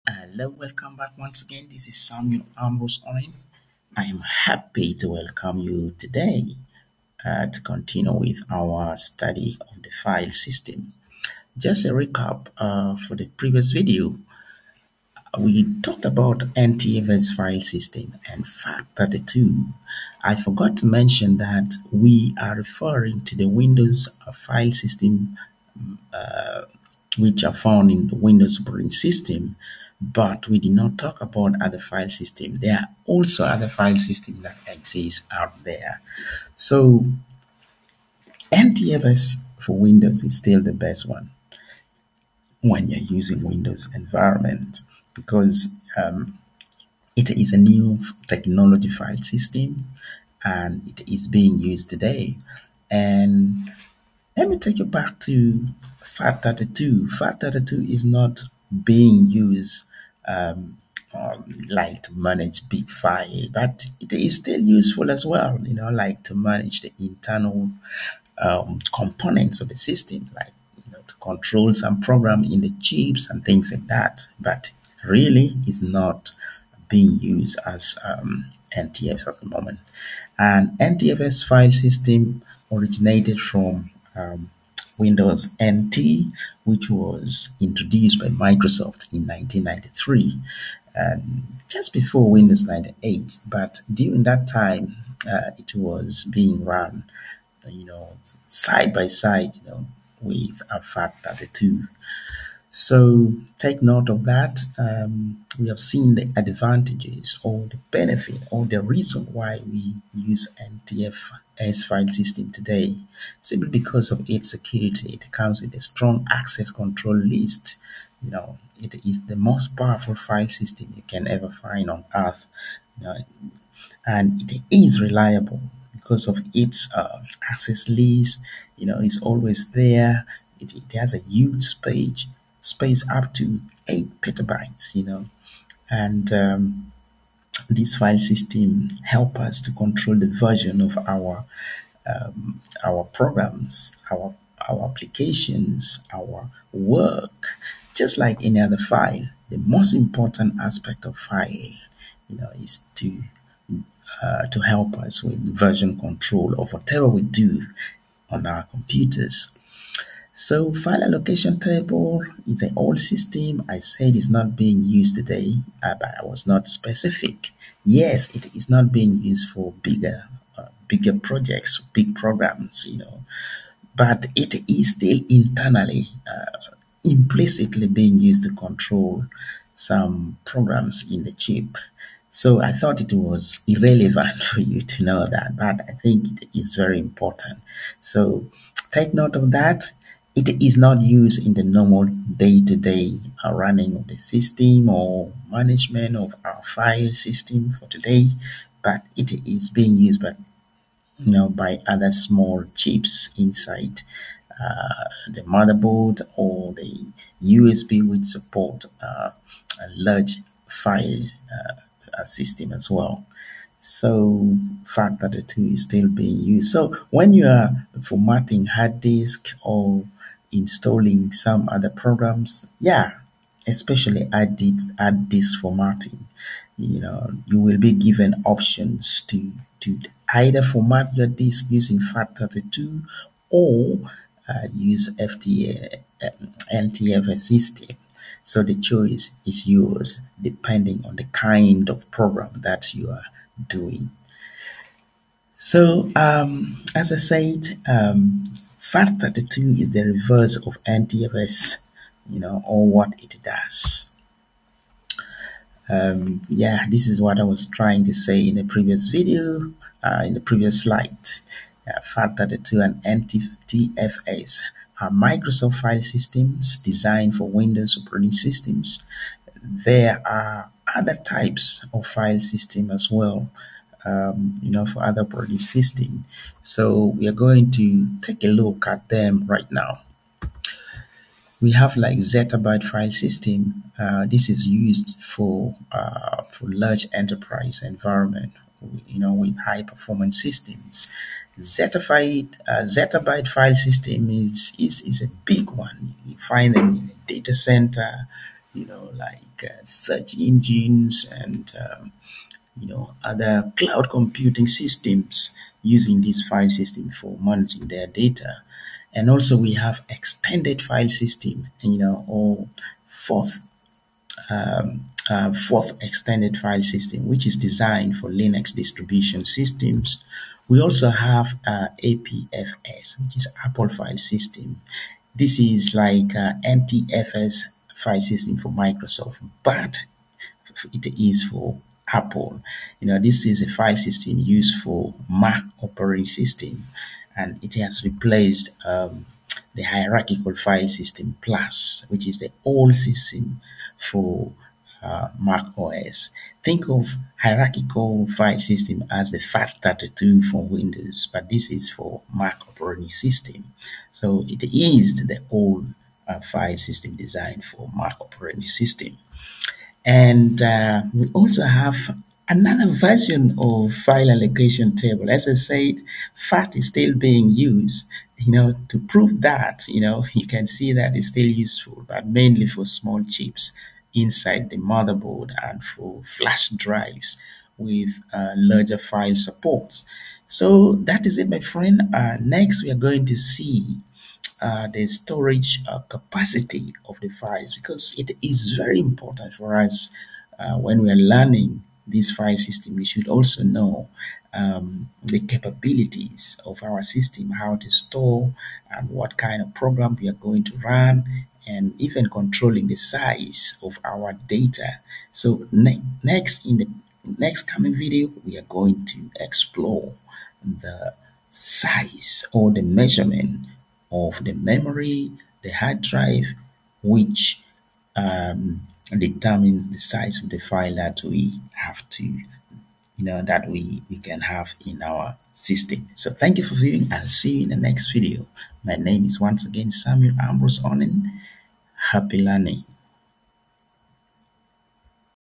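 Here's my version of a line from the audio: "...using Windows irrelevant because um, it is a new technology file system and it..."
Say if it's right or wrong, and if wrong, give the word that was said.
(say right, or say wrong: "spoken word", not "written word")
wrong: "environment", not "irrelevant".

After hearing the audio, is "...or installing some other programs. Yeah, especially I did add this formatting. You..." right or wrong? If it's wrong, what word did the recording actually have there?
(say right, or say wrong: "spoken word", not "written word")
right.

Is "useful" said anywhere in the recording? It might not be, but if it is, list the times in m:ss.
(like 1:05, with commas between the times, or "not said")
1:04, 6:11.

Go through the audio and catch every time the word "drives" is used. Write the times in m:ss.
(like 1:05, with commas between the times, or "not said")
6:16, 6:56.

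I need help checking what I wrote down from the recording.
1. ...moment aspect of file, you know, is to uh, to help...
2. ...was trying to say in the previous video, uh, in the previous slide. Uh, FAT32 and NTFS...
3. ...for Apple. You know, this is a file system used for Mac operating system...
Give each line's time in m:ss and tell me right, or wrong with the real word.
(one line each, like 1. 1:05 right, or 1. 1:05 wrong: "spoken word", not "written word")
1. 2:29 wrong: "important", not "moment"
2. 4:17 right
3. 5:31 right.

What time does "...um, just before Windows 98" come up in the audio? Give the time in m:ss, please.
1:30.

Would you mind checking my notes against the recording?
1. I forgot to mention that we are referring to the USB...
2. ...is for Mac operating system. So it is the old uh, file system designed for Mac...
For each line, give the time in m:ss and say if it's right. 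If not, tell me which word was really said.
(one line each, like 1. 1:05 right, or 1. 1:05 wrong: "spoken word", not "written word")
1. 0:20 wrong: "Windows", not "USB"
2. 5:51 right.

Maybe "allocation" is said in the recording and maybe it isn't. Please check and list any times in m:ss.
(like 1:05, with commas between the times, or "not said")
2:41, 6:04.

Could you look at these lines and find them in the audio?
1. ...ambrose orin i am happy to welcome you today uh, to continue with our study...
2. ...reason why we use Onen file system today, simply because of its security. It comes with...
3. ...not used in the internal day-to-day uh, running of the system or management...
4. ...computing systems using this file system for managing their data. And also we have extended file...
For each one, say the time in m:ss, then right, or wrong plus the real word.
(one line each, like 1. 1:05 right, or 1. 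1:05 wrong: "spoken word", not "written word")
1. 0:02 right
2. 1:48 wrong: "NTFS", not "Onen"
3. 3:10 wrong: "normal", not "internal"
4. 5:04 right.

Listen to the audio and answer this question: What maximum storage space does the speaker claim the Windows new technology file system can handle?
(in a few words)
8 petabytes.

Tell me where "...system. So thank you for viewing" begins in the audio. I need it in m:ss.
7:05.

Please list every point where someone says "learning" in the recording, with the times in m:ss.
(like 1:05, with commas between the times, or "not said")
6:31, 7:12.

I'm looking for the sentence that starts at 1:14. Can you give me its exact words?
But really, it's not being used as um, NTFS at the moment.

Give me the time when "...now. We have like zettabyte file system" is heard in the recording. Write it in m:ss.
4:39.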